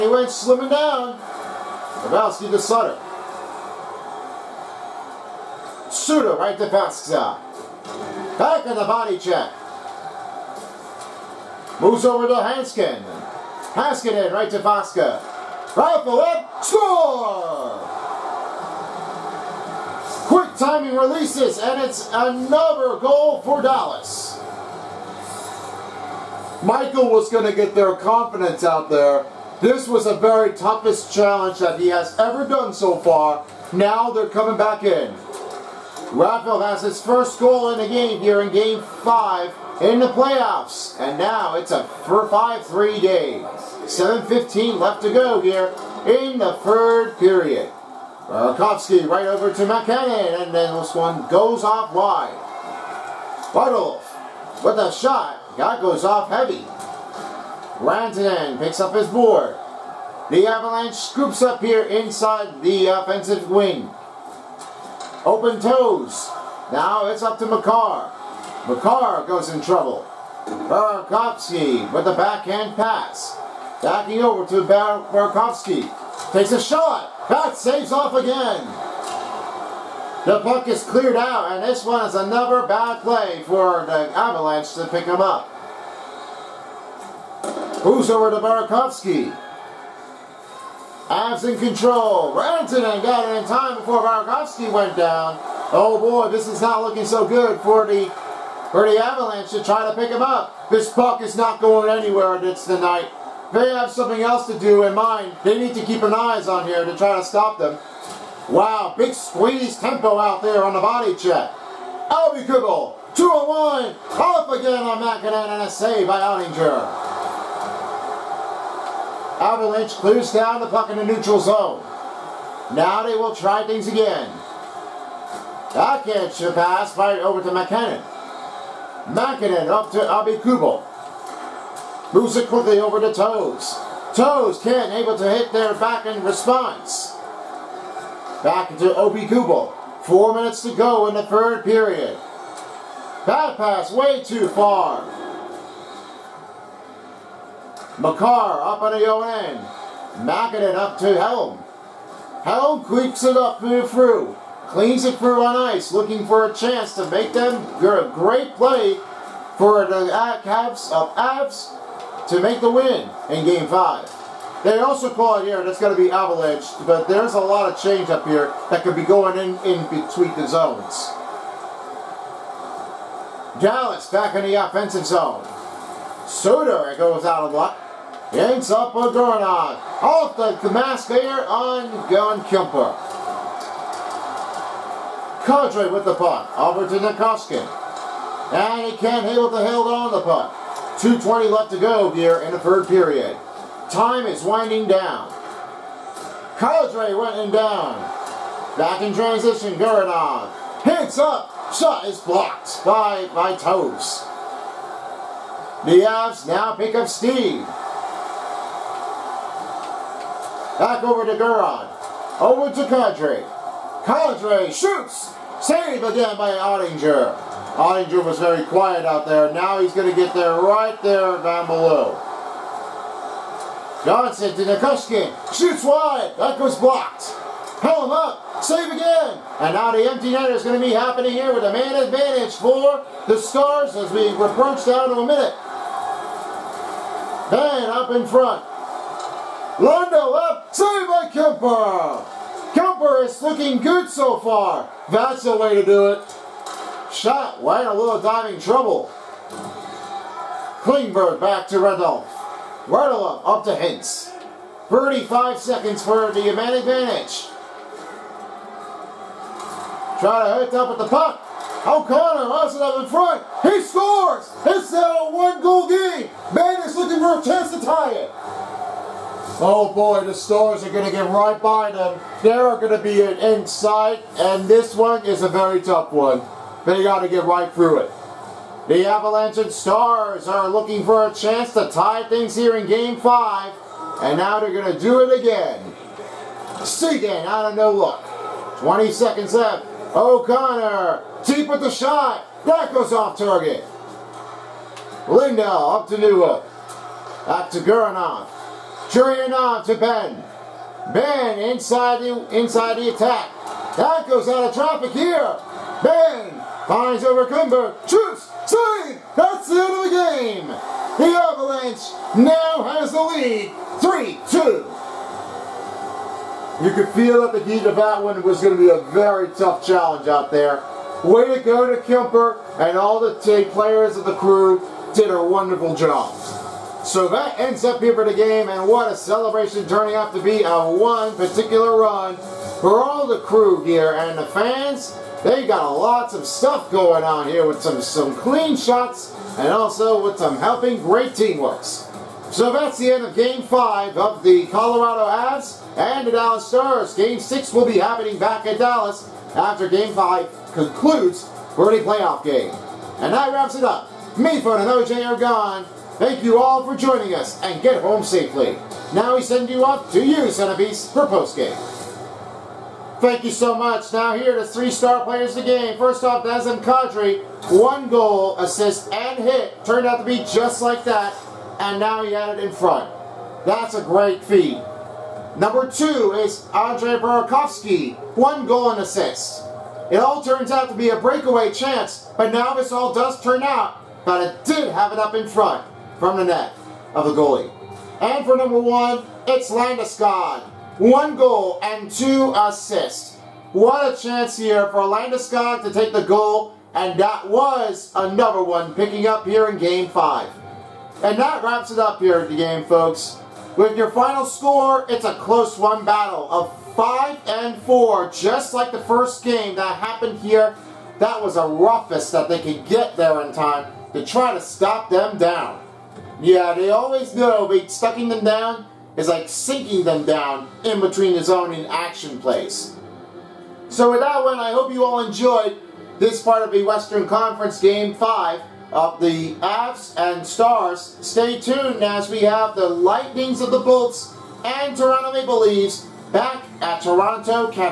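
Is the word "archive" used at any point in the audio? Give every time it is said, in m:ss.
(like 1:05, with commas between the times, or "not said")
not said.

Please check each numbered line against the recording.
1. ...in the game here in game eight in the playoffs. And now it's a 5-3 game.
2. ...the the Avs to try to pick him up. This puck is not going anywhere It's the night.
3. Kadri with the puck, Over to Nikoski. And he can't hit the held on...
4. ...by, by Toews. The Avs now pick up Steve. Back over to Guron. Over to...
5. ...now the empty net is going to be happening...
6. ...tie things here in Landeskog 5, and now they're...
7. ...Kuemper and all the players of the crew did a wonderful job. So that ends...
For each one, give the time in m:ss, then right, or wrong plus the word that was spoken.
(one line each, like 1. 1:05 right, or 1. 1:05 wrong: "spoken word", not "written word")
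1. 0:37 wrong: "five", not "eight"
2. 1:37 wrong: "Avalanche", not "Avs"
3. 3:05 right
4. 3:22 right
5. 3:49 right
6. 4:41 wrong: "Game", not "Landeskog"
7. 5:22 right.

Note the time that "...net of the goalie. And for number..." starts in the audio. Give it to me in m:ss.
6:26.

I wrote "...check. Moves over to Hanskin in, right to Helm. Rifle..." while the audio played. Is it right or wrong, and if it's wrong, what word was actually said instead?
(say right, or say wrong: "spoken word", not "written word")
wrong: "Vasca", not "Helm".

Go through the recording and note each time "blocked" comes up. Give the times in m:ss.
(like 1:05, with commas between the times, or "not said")
3:22, 3:46.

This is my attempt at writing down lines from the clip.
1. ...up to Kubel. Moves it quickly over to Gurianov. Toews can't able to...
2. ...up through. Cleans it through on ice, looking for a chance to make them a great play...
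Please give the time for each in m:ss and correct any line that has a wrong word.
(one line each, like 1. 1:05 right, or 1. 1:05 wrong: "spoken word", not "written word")
1. 2:09 wrong: "Toews", not "Gurianov"
2. 2:33 right.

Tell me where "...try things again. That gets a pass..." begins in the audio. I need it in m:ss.
2:03.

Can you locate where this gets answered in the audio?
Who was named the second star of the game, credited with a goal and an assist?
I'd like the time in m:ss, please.
6:16.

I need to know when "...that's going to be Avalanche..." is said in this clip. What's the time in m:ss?
2:45.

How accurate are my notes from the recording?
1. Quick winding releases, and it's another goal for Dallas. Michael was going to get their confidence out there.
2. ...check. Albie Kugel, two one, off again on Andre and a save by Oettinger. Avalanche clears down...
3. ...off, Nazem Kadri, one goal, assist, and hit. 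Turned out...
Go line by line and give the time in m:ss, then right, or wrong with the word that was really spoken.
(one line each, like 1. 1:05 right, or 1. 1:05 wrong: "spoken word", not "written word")
1. 0:20 wrong: "timing", not "winding"
2. 1:51 wrong: "MacKinnon", not "Andre"
3. 6:06 right.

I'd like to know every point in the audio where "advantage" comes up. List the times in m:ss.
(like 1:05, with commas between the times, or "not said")
3:51, 4:16.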